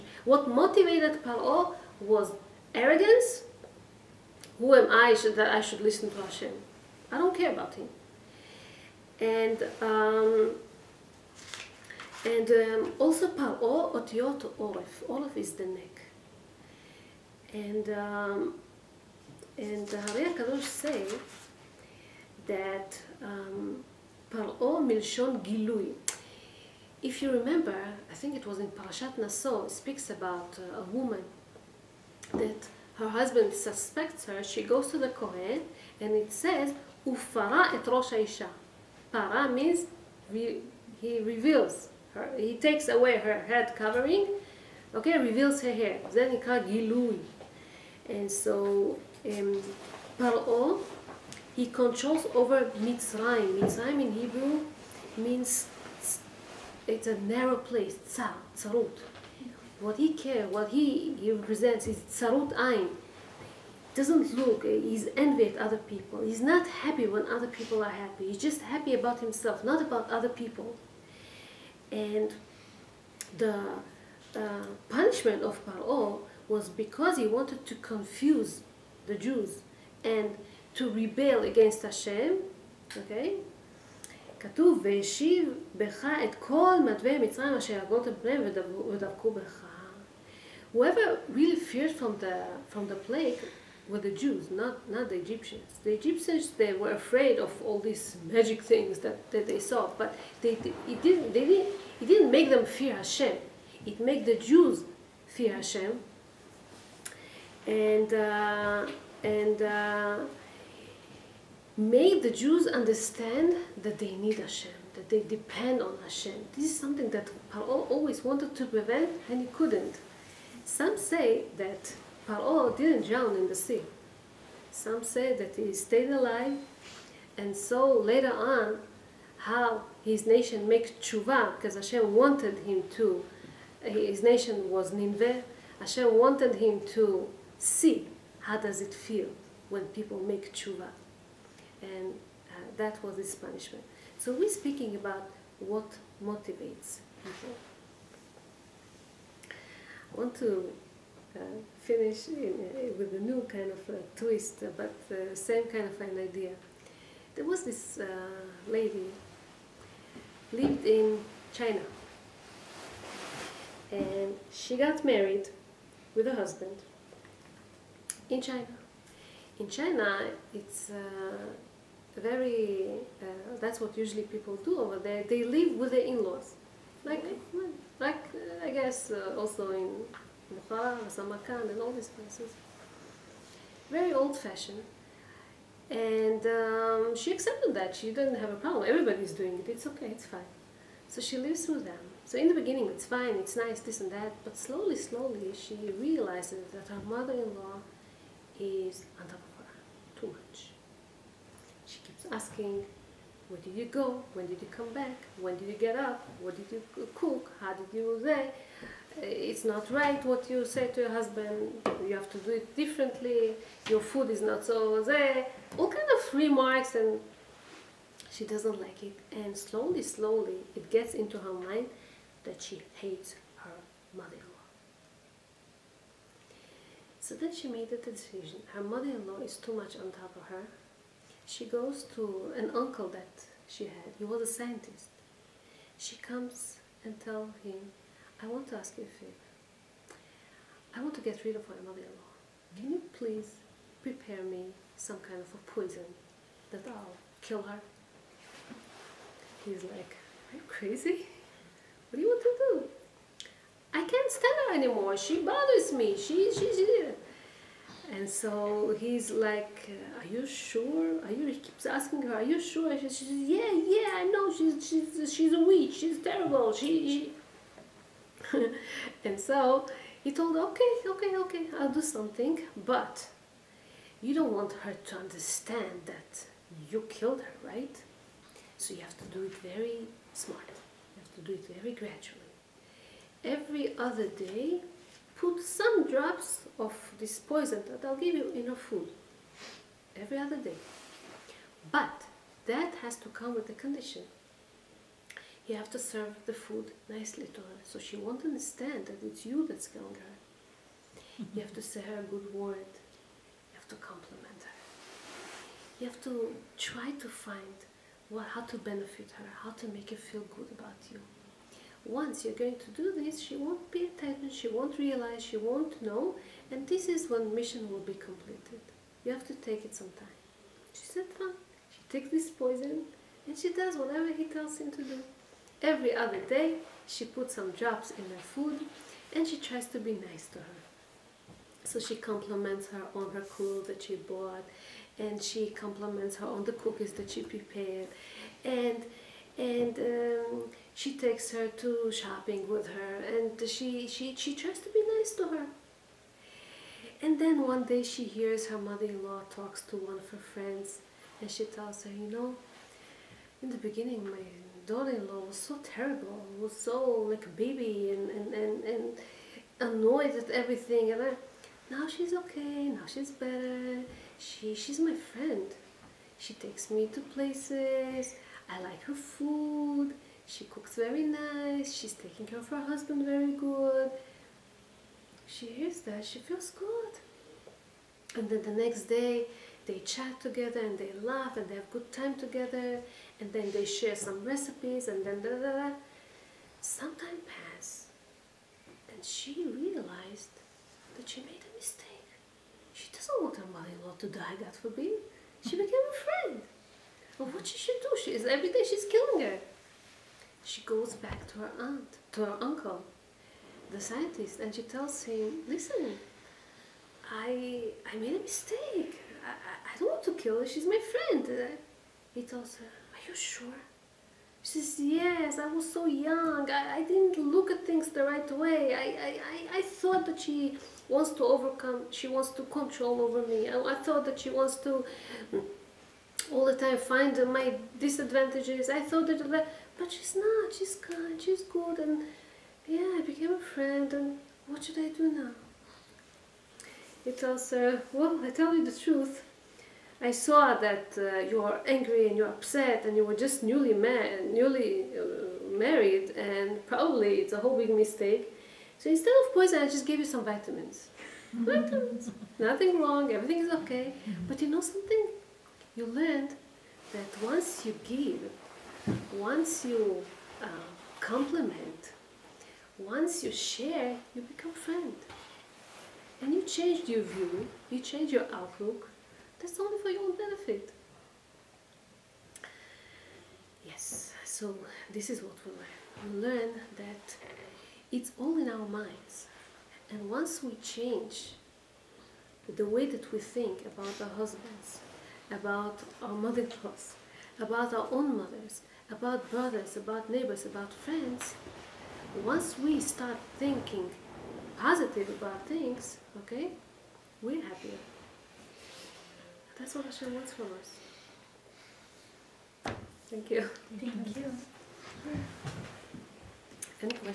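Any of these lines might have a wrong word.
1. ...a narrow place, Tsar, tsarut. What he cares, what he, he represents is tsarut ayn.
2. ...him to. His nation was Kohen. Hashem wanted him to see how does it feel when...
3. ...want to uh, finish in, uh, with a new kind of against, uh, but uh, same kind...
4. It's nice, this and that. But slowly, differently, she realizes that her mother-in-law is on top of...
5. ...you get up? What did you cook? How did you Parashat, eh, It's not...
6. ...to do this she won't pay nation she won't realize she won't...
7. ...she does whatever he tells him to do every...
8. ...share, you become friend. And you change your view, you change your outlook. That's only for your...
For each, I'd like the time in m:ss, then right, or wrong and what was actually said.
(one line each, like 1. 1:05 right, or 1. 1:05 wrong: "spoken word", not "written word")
1. 0:57 right
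2. 2:12 wrong: "Nineveh", not "Kohen"
3. 2:30 wrong: "twist", not "against"
4. 3:13 wrong: "slowly", not "differently"
5. 3:25 wrong: "There", not "Parashat"
6. 5:12 wrong: "attention", not "nation"
7. 5:23 right
8. 7:43 right.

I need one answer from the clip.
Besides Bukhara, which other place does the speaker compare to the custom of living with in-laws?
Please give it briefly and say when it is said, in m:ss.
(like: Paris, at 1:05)
Samarkand, at 3:01.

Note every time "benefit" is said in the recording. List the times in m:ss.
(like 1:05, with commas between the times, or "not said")
5:08, 7:50.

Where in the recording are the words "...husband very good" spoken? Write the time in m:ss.
6:12.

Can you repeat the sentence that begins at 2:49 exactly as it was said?
In China, it's very, uh, that's what usually people do over there.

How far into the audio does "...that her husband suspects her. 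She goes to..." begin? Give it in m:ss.
0:32.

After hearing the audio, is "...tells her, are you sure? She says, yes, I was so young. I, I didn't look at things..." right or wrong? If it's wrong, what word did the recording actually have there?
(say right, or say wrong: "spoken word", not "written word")
right.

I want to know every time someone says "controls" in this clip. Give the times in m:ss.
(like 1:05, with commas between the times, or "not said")
0:51, 7:02.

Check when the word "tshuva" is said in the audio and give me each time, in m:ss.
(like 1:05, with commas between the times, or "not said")
2:10, 2:20.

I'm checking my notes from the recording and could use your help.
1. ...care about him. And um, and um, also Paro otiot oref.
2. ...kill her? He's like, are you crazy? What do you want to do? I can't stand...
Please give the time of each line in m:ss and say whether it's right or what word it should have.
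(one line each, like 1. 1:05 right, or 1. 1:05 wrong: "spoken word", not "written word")
1. 0:07 right
2. 4:07 right.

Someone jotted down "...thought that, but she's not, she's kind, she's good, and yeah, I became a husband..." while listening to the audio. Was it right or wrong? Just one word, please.
wrong.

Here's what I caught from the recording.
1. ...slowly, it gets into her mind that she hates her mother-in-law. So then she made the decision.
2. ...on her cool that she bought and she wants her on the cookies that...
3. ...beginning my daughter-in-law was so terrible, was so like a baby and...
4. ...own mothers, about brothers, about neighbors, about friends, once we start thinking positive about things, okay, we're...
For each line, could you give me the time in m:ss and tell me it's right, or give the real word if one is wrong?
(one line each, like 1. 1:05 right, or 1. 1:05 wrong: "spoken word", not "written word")
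1. 3:40 right
2. 5:33 wrong: "compliments", not "wants"
3. 5:53 right
4. 8:08 right.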